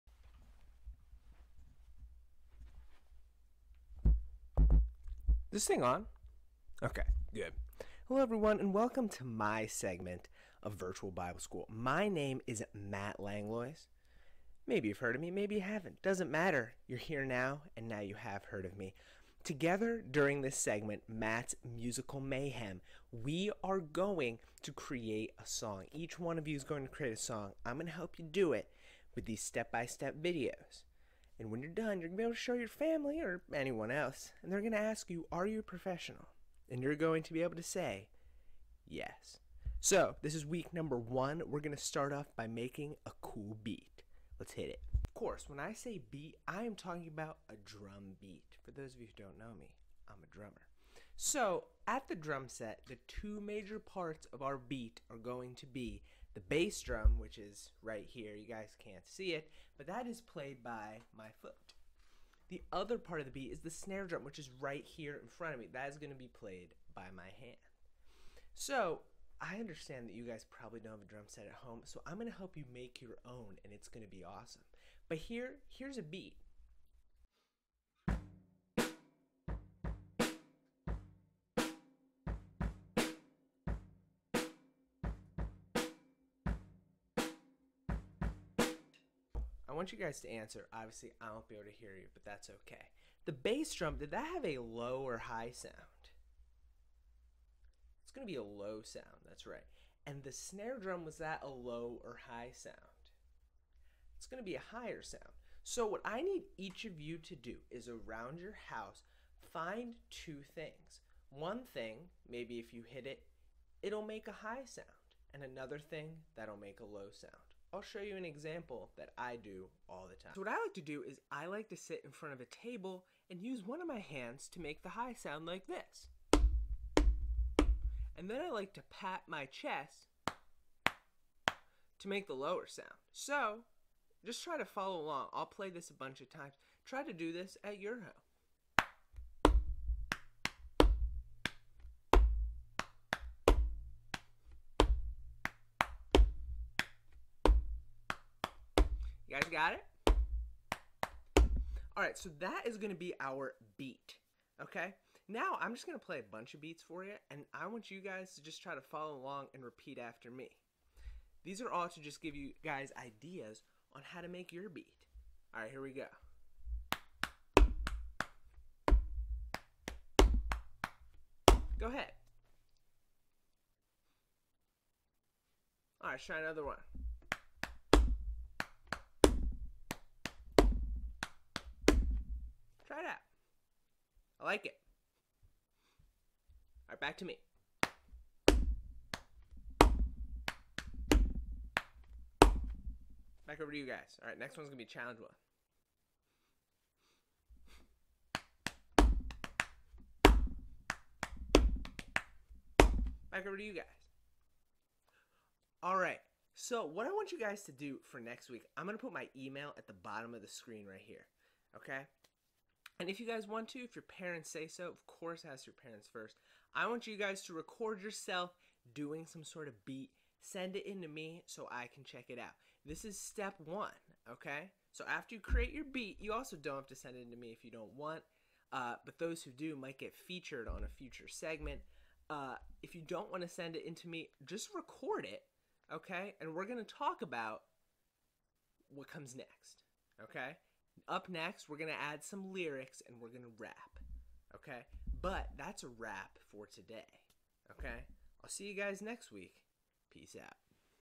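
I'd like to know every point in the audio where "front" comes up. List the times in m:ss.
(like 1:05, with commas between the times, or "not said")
1:05, 2:02.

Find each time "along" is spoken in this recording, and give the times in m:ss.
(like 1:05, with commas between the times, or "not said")
2:14, 2:39.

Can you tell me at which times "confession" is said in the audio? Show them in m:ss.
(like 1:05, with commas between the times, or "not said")
not said.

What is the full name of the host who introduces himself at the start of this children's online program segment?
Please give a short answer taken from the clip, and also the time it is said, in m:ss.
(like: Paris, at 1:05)
Matt Langlois, at 0:12.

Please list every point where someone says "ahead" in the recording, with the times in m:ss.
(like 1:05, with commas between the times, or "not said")
2:51.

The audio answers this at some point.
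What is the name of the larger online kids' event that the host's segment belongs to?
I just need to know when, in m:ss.
0:10.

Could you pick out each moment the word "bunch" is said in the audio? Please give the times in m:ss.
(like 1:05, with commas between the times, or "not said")
2:15, 2:36.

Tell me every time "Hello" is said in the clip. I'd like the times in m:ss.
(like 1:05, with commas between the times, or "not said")
0:08.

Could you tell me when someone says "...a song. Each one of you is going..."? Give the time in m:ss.
0:25.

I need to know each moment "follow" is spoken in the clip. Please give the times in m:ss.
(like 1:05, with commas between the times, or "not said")
2:14, 2:38.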